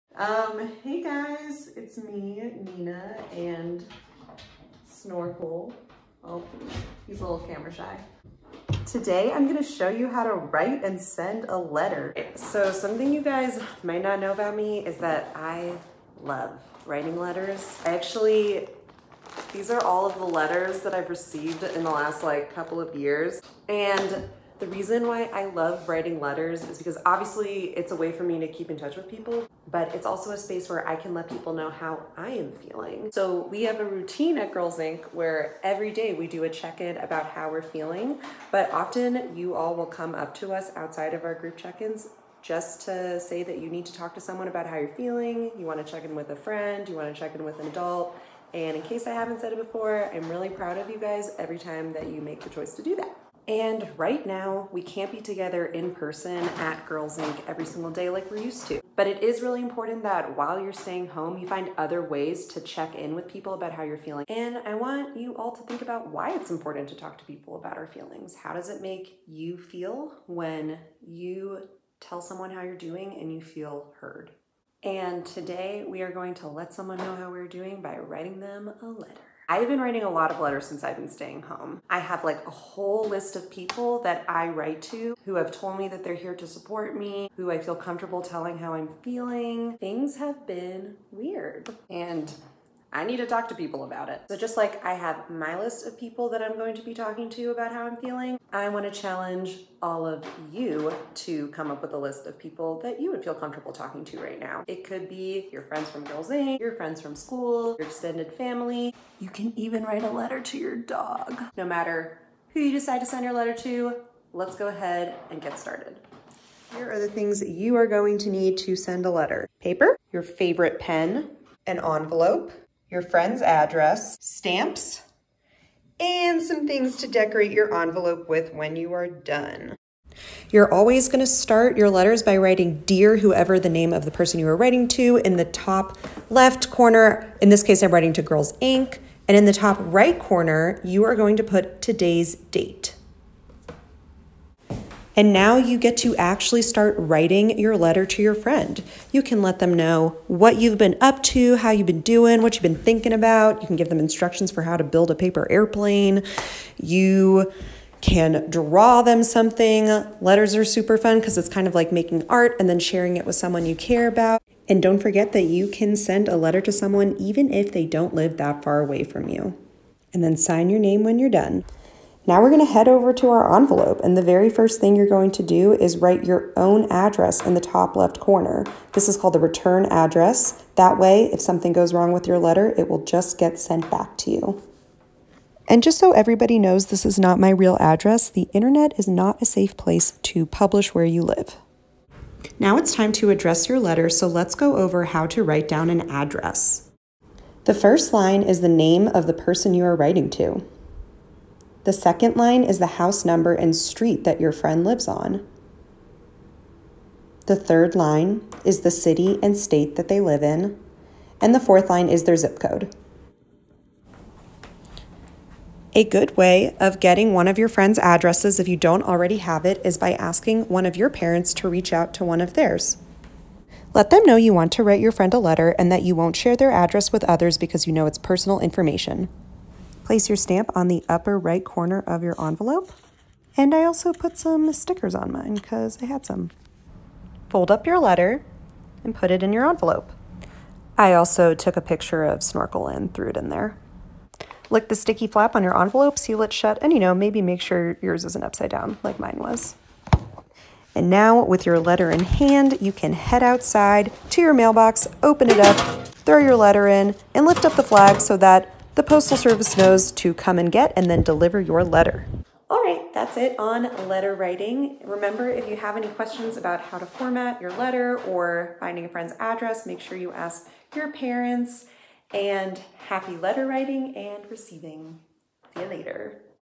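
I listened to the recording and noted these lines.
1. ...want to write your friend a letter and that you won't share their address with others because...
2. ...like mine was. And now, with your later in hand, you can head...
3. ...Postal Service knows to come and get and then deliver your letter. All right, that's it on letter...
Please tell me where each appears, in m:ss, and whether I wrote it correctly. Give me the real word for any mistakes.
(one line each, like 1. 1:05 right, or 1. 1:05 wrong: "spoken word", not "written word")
1. 3:44 right
2. 4:09 wrong: "letter", not "later"
3. 4:19 right.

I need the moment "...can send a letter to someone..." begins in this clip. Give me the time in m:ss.
2:45.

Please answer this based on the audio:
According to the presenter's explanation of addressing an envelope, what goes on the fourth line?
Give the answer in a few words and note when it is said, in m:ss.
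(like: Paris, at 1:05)
zip code, at 3:32.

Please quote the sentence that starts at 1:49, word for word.
You can even write a letter to your dog.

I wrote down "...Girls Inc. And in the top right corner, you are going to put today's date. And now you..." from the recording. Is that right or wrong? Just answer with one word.
right.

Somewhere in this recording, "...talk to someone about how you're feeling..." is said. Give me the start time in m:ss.
0:43.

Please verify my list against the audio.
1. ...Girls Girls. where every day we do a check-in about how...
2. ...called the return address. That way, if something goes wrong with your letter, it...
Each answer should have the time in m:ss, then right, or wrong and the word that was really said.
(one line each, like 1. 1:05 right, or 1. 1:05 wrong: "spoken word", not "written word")
1. 0:34 wrong: "Inc", not "Girls"
2. 2:59 right.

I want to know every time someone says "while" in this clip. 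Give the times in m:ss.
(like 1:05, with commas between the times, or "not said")
1:00.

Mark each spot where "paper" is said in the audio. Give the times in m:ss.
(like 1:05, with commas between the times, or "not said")
1:59, 2:35.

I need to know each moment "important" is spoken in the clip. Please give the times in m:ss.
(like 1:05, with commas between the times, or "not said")
0:59, 1:06.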